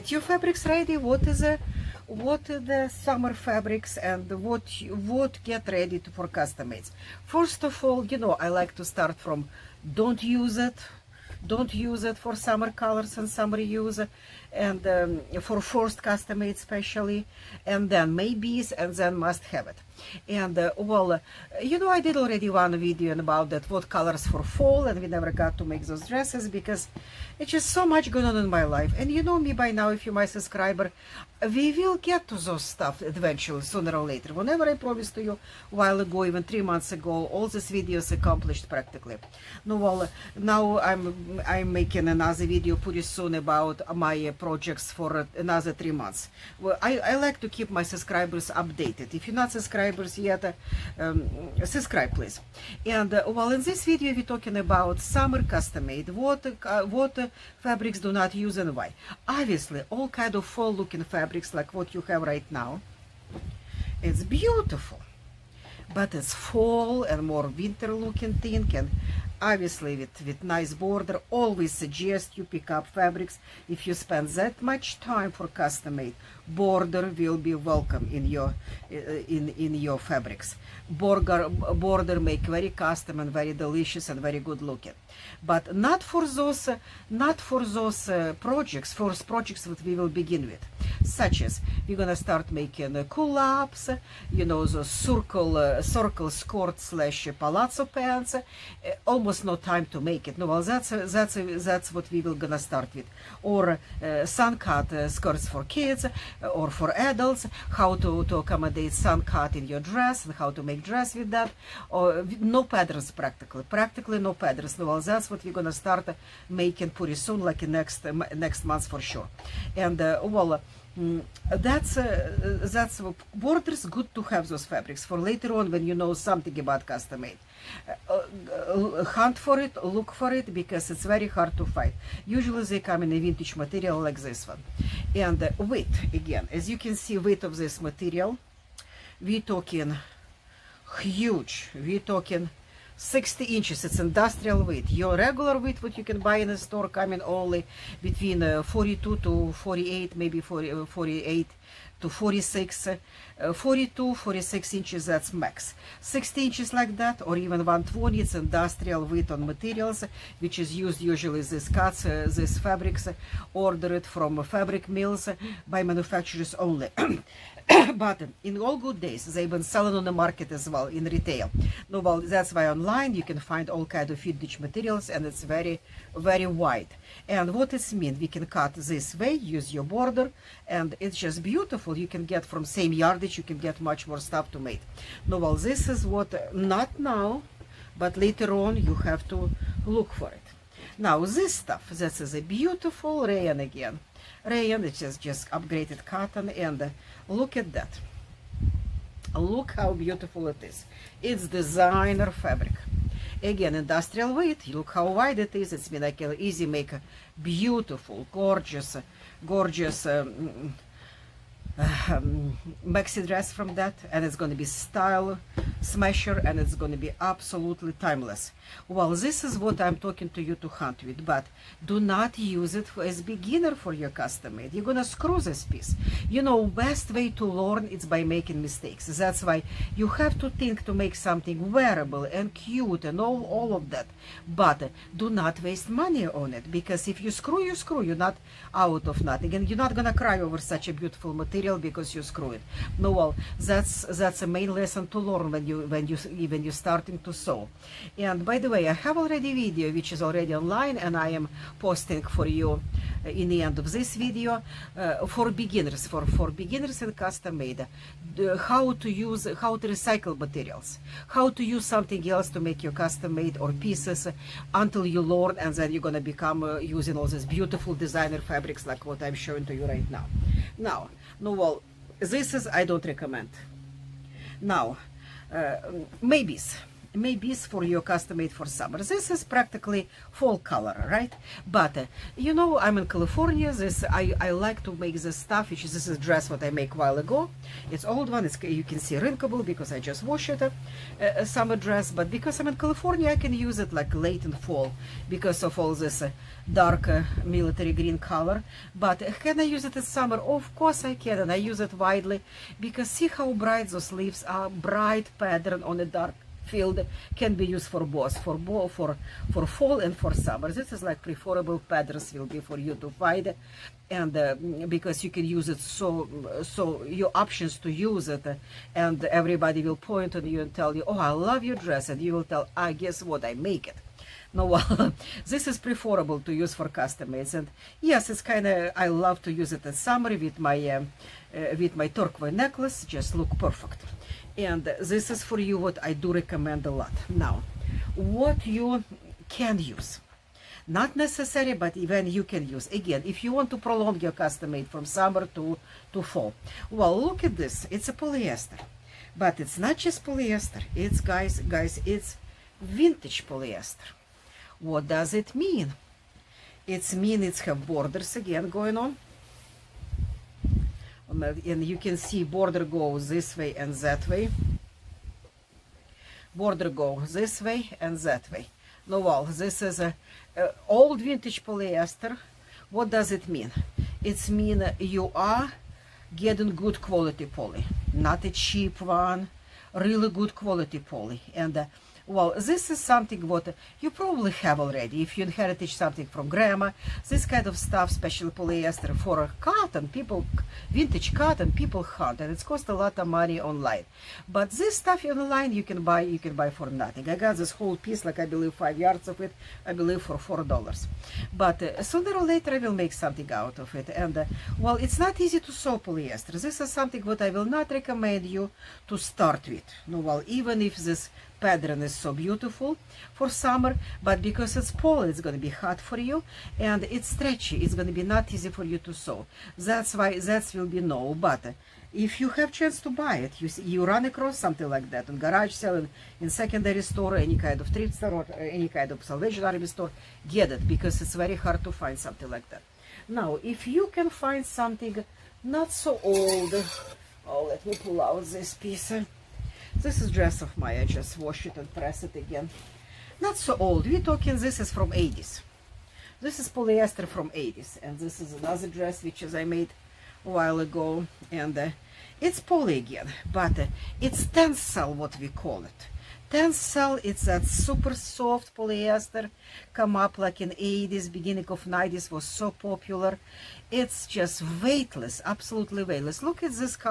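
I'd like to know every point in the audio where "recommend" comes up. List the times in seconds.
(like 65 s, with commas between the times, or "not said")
273 s, 336 s, 407 s.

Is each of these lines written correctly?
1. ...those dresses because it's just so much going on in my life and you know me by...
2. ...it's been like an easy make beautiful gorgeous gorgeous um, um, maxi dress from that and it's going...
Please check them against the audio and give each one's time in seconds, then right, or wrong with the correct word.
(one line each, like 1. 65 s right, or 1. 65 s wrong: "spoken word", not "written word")
1. 25 s right
2. 205 s right.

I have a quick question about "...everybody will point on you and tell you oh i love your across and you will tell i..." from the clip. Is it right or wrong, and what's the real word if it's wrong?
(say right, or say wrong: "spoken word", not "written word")
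wrong: "dress", not "across".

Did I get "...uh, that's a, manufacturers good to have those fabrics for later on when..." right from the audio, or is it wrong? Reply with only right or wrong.
wrong.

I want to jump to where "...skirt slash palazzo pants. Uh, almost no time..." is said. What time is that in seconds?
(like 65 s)
96 s.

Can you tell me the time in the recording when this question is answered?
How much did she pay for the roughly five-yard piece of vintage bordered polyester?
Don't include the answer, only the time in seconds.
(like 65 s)
400 s.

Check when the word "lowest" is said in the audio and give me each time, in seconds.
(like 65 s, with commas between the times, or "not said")
not said.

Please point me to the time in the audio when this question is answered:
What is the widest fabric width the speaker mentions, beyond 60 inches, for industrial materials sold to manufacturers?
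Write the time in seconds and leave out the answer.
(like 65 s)
157 s.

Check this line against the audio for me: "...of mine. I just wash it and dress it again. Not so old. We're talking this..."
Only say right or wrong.
wrong.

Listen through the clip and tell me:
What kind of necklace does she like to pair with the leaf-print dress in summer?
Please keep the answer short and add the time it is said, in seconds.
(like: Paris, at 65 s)
turquoise, at 332 s.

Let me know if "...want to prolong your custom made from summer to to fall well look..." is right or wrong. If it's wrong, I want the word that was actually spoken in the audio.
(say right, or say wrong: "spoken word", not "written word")
right.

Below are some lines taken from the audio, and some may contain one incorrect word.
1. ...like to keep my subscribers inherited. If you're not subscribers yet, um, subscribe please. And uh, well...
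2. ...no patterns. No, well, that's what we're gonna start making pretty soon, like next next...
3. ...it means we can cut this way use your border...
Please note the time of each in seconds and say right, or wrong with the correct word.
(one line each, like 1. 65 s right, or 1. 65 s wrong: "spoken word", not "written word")
1. 47 s wrong: "updated", not "inherited"
2. 114 s right
3. 177 s right.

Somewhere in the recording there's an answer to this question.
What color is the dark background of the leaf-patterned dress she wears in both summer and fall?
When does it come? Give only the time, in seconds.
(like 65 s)
297 s.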